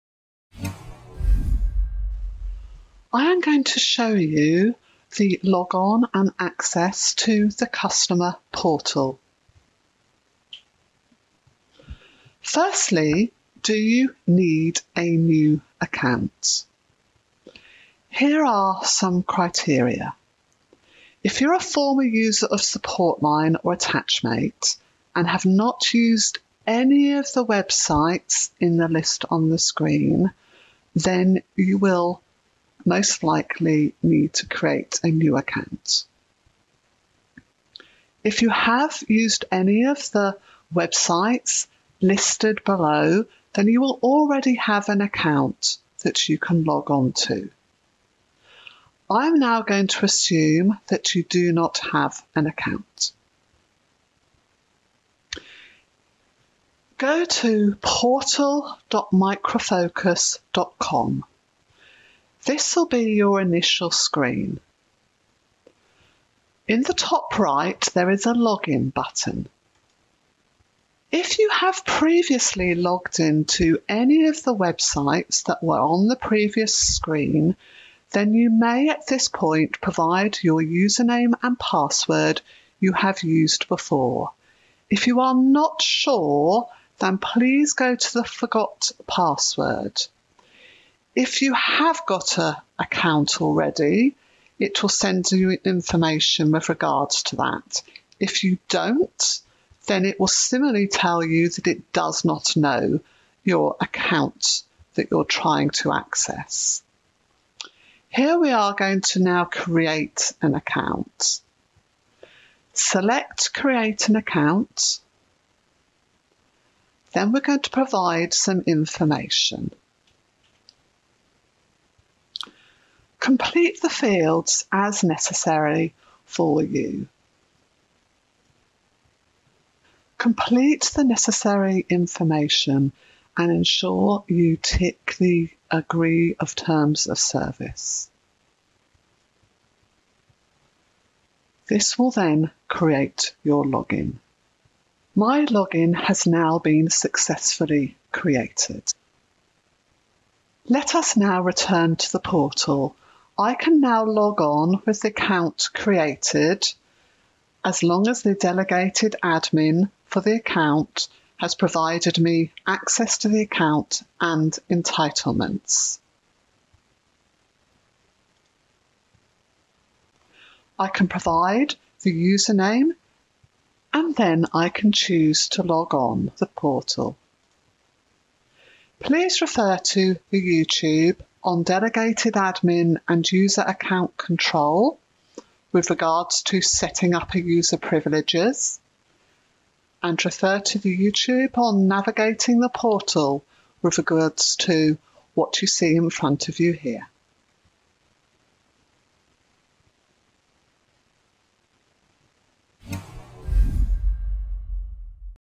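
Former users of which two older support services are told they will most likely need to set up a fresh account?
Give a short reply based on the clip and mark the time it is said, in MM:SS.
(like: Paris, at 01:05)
Supportline or Attachmate, at 00:22.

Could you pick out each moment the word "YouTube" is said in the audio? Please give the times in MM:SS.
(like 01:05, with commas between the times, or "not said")
03:00, 03:10.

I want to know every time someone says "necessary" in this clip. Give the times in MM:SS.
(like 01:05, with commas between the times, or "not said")
02:05, 02:11.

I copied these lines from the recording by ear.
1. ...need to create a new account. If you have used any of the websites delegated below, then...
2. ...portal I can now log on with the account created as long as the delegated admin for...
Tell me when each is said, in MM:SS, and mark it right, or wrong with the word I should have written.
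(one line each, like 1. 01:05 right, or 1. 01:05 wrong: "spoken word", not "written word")
1. 00:34 wrong: "listed", not "delegated"
2. 02:32 right.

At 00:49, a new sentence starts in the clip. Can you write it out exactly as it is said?
I'm now going to assume that you do not have an account.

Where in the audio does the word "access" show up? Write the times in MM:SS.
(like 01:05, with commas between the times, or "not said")
00:06, 01:45, 02:42.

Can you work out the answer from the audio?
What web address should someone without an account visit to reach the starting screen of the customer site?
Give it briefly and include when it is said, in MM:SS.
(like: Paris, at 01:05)
portal.microfocus.com, at 00:57.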